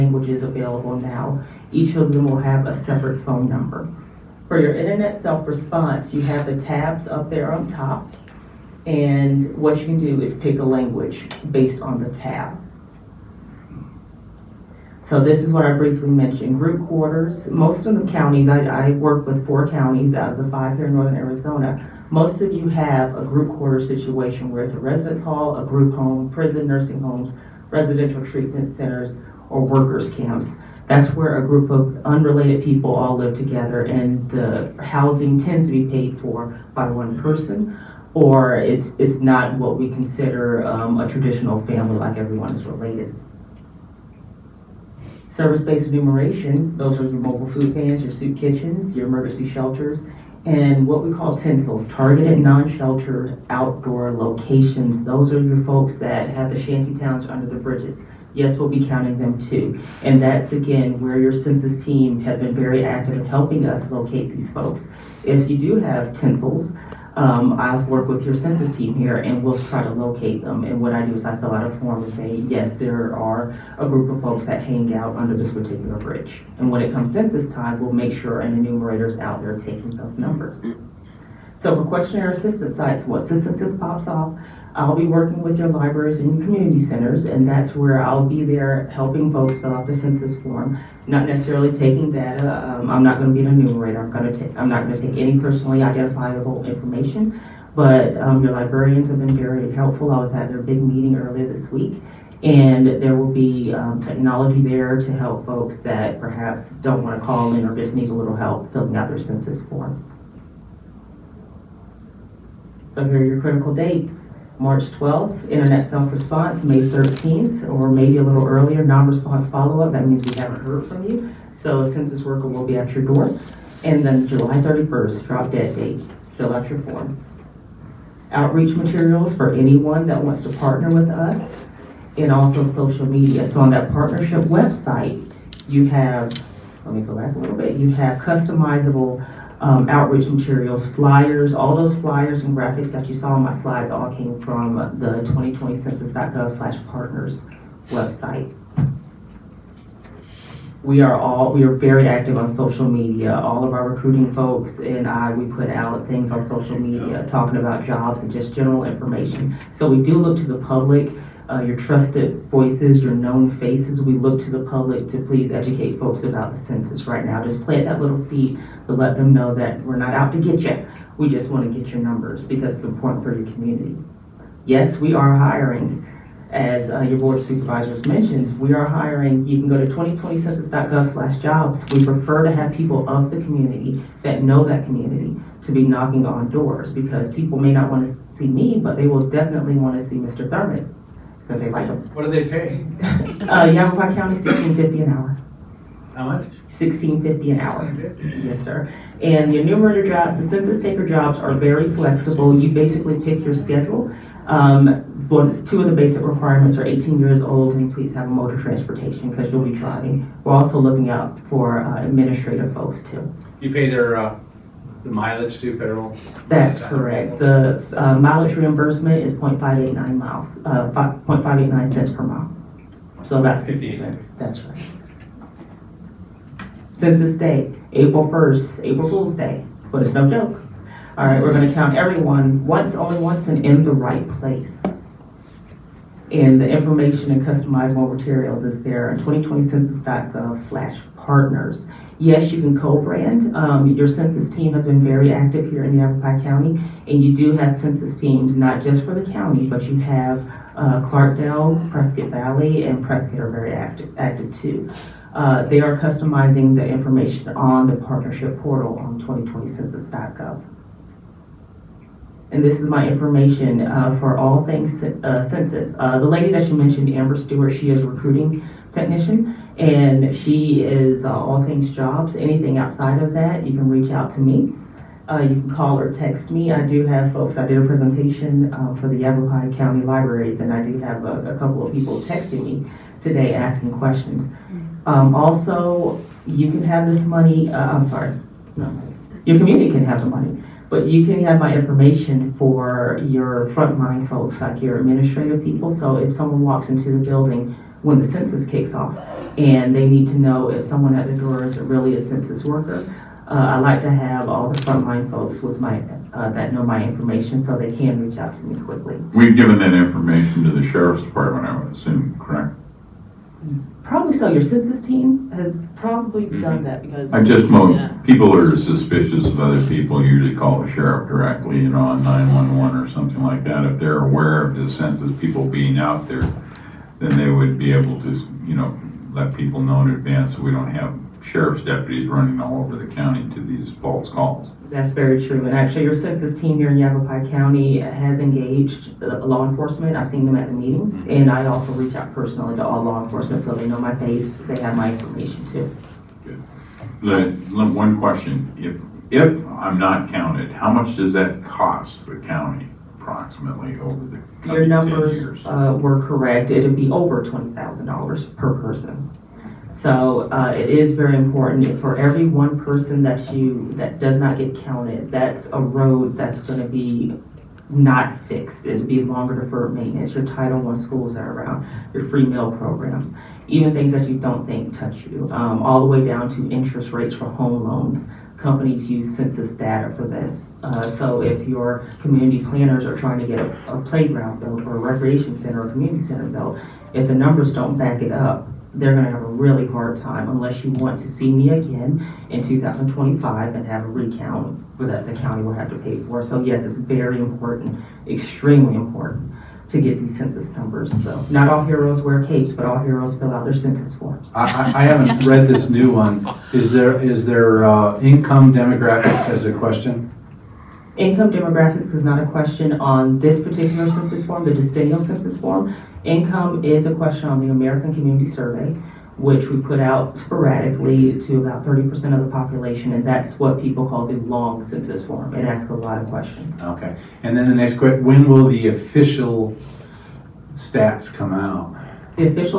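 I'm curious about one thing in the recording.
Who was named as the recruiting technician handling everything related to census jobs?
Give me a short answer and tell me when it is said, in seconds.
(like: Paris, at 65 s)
Amber Stewart, at 267 s.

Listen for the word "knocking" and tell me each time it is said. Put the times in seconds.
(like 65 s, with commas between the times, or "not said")
185 s.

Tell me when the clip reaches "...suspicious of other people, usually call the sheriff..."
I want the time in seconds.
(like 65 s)
318 s.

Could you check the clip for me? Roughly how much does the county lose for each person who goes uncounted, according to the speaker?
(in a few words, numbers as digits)
Over $20,000.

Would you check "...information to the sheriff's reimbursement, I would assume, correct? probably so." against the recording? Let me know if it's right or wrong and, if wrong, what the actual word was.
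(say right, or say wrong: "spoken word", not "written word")
wrong: "department", not "reimbursement".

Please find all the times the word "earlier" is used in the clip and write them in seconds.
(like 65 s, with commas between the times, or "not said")
101 s, 118 s.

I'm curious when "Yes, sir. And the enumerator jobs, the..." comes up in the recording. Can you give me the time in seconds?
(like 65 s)
198 s.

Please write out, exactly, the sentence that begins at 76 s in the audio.
And when it comes census time, we'll make sure an enumerator is out there taking those numbers.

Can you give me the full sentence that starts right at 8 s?
And what you can do is pick a language based on the tab.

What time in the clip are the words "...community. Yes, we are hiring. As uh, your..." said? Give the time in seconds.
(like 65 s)
173 s.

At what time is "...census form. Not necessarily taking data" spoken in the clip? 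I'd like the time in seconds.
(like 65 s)
89 s.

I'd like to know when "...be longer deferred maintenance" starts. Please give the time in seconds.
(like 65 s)
369 s.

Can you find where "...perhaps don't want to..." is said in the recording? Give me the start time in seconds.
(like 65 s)
106 s.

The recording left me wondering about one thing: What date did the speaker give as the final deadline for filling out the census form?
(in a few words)
July 31st.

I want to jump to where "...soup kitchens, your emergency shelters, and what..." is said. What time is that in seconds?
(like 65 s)
48 s.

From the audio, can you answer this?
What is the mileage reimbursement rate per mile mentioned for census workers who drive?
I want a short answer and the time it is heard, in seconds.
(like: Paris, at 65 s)
0.589 per mile, at 221 s.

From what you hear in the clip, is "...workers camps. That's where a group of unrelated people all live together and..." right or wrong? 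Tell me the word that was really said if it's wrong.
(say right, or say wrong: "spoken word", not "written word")
right.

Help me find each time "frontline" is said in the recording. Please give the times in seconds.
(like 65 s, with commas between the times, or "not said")
293 s, 304 s.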